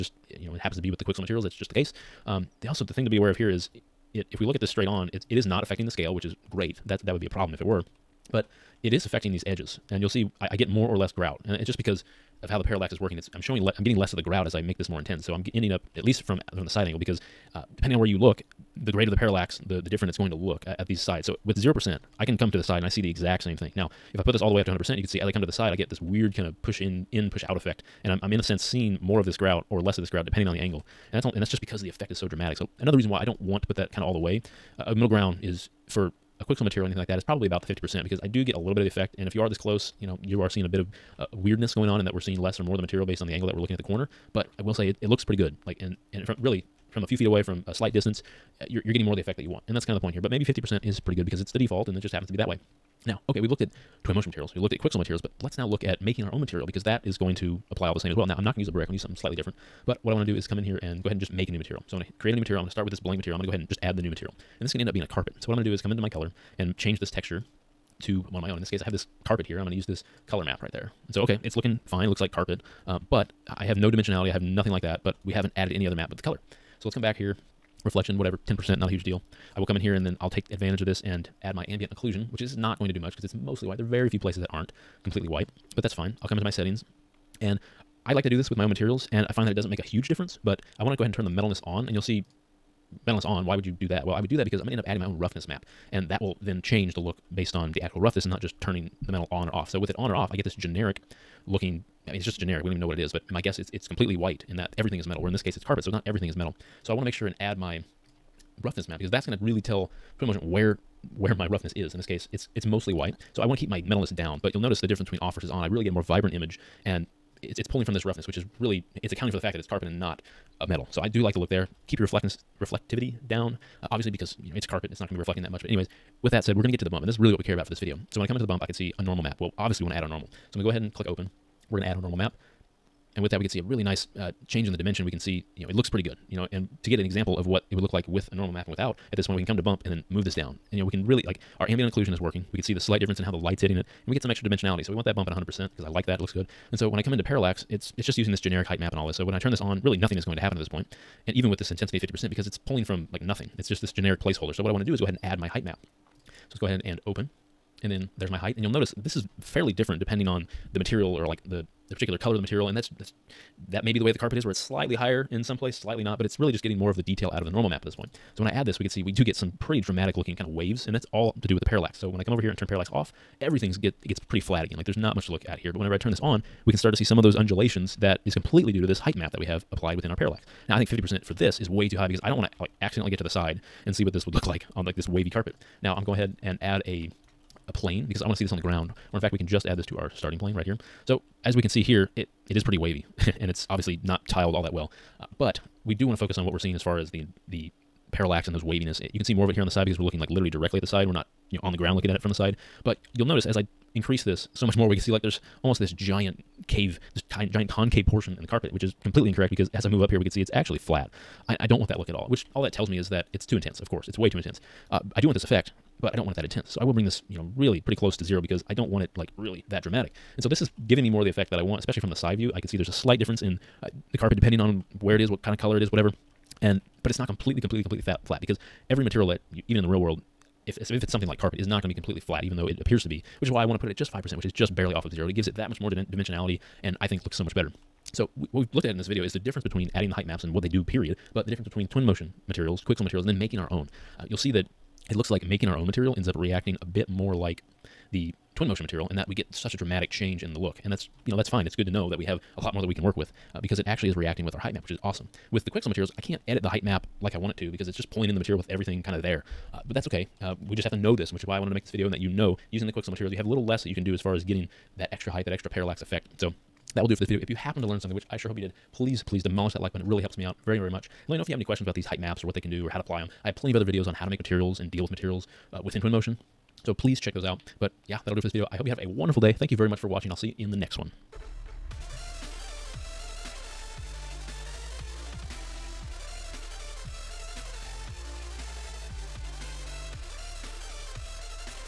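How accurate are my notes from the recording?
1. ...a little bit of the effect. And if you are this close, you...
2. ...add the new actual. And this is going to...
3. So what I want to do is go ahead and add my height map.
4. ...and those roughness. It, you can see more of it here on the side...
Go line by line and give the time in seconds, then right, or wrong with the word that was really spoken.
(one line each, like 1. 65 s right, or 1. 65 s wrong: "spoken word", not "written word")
1. 38 s right
2. 63 s wrong: "material", not "actual"
3. 154 s right
4. 198 s wrong: "waviness", not "roughness".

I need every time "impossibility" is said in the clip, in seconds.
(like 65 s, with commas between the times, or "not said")
not said.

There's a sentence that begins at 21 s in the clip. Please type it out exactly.
So with zero percent, I can come to the side and I see the exact same thing.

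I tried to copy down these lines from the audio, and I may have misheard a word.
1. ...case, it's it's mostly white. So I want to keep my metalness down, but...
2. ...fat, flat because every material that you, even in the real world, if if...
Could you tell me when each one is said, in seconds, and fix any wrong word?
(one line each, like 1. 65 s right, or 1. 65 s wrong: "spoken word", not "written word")
1. 112 s right
2. 228 s right.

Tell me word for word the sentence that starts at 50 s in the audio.
But maybe 50% is pretty good because it's the default and it just happens to be that way.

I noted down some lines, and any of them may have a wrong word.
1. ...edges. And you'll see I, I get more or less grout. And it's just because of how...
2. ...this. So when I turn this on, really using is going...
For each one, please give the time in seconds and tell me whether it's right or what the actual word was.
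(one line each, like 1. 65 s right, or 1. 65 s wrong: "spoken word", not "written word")
1. 9 s right
2. 149 s wrong: "nothing", not "using".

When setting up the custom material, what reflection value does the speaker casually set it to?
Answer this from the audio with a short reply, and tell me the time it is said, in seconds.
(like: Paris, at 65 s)
10%, at 78 s.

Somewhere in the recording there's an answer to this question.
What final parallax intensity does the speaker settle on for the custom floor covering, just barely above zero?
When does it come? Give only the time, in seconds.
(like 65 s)
234 s.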